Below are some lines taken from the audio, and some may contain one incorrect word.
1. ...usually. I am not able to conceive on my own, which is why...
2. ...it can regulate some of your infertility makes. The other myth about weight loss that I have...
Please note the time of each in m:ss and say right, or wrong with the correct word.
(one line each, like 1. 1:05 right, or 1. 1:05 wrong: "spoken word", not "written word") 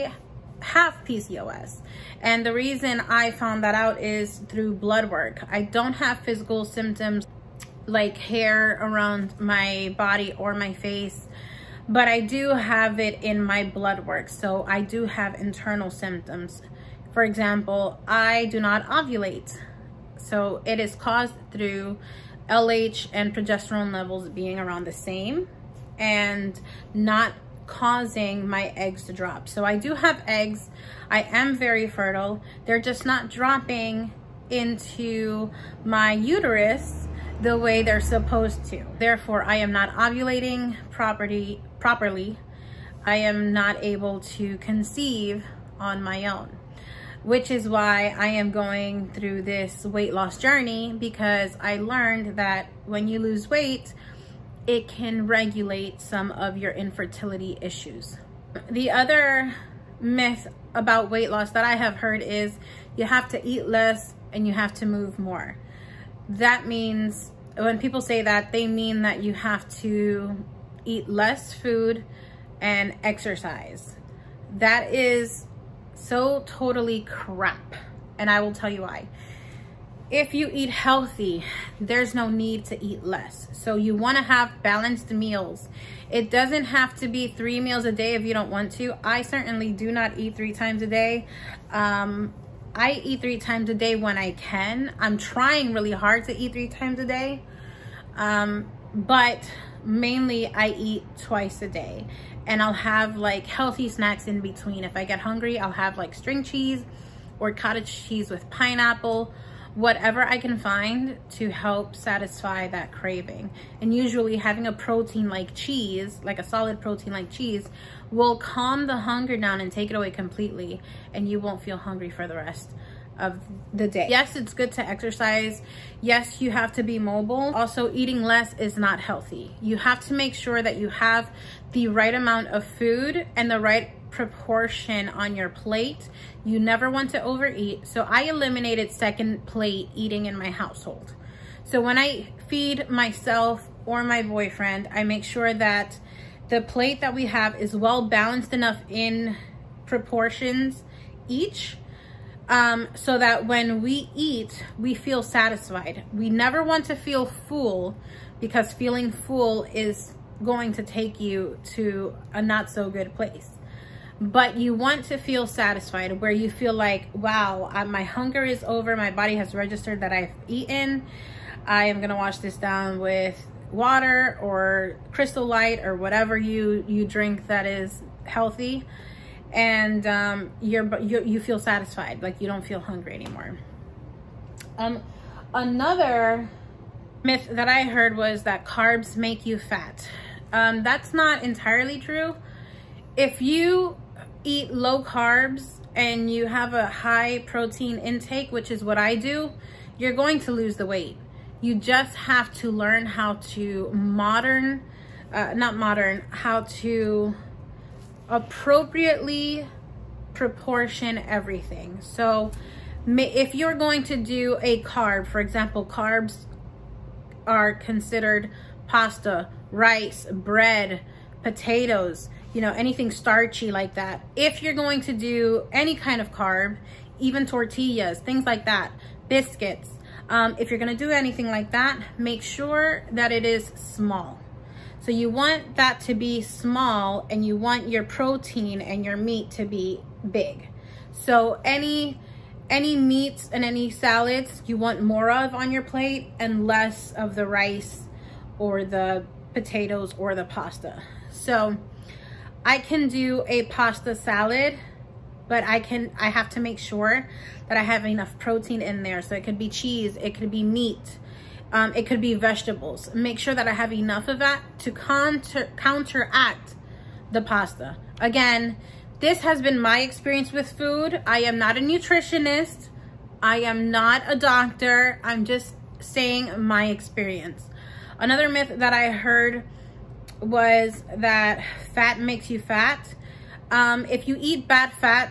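1. 0:41 wrong: "properly", not "usually"
2. 0:54 wrong: "issues", not "makes".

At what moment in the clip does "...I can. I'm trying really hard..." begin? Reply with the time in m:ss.
1:34.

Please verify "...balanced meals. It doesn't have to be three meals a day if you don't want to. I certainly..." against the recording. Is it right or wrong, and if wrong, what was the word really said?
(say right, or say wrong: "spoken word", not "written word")
right.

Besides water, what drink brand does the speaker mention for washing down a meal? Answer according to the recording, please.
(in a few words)
Crystal Light.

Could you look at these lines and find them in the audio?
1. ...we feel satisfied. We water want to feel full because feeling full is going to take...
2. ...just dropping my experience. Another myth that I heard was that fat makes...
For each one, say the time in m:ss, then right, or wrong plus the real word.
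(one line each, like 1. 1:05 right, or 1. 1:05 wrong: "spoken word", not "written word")
1. 2:34 wrong: "never", not "water"
2. 4:35 wrong: "saying", not "dropping".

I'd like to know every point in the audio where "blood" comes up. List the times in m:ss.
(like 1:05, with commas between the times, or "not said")
0:04, 0:13.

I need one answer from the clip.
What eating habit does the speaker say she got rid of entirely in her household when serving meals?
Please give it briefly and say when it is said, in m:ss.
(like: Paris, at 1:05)
second plate eating, at 2:18.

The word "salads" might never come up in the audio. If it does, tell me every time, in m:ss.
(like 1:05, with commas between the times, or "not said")
4:03, 4:14.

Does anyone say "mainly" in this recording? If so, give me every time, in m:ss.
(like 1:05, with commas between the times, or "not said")
1:39.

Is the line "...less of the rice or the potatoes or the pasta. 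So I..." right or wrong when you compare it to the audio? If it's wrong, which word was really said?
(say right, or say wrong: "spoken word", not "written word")
right.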